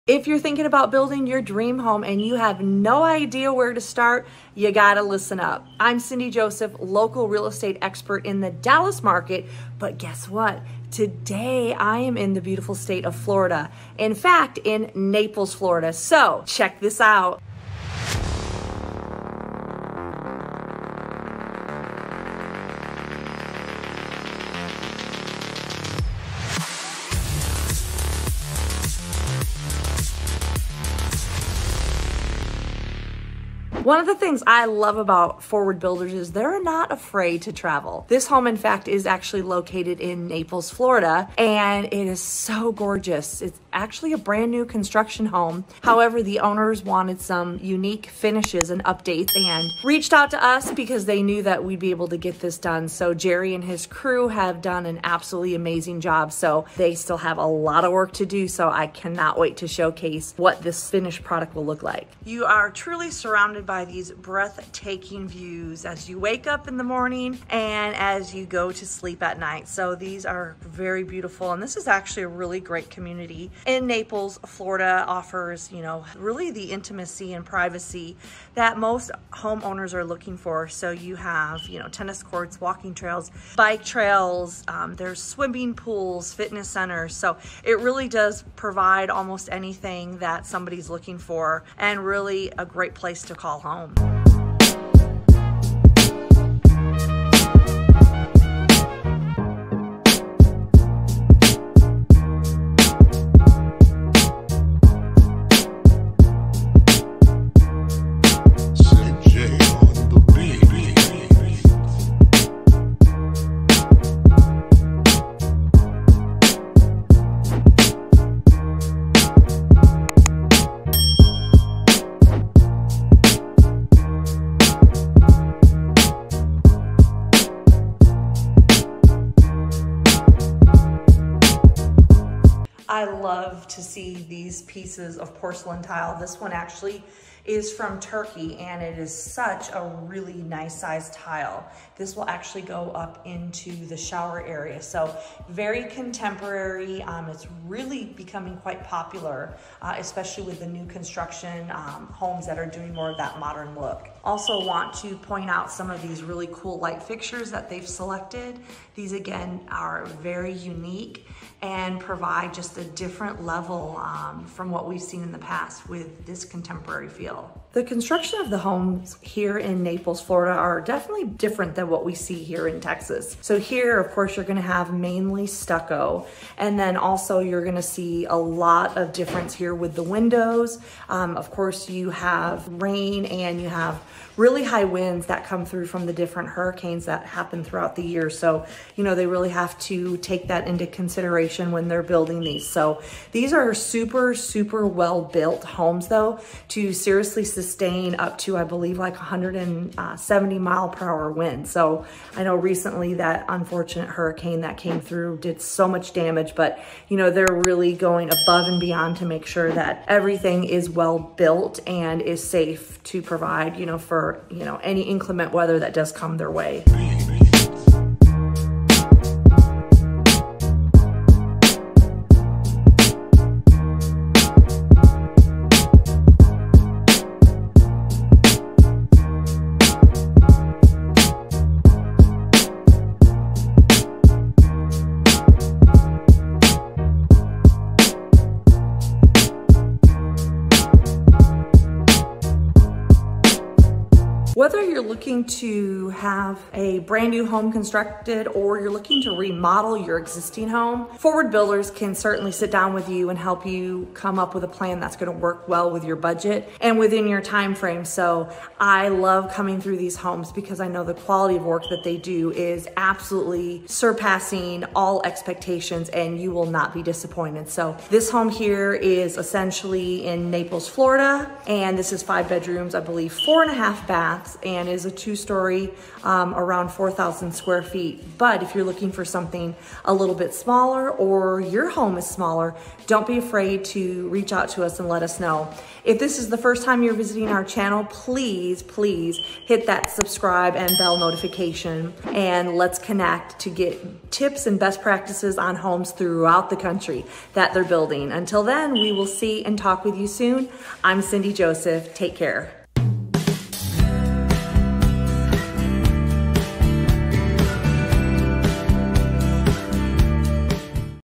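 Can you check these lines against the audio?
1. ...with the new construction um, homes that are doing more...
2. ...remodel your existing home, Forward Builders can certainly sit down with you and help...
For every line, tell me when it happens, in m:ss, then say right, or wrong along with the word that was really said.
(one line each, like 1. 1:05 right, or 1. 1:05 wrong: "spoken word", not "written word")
1. 2:30 right
2. 4:09 right.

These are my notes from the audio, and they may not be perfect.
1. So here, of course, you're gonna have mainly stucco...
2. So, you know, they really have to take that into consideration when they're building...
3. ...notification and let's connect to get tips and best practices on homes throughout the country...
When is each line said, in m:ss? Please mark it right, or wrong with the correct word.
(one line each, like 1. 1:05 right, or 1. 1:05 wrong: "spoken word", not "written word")
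1. 2:53 right
2. 3:08 right
3. 4:51 right.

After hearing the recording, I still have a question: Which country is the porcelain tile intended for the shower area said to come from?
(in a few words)
Turkey.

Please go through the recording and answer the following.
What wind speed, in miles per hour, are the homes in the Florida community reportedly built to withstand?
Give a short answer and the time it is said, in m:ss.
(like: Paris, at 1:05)
170, at 3:19.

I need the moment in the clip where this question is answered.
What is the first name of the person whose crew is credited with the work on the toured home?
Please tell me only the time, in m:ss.
0:53.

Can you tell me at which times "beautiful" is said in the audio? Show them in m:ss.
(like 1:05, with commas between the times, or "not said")
0:12, 1:11.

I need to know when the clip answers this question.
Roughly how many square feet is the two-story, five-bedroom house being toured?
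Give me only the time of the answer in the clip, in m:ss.
4:36.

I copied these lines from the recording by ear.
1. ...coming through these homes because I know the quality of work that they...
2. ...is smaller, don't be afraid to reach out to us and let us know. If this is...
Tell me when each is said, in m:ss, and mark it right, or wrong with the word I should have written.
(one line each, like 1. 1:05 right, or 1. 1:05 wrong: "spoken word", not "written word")
1. 4:19 right
2. 4:42 right.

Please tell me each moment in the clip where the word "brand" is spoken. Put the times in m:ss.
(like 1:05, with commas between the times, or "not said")
0:44, 4:06.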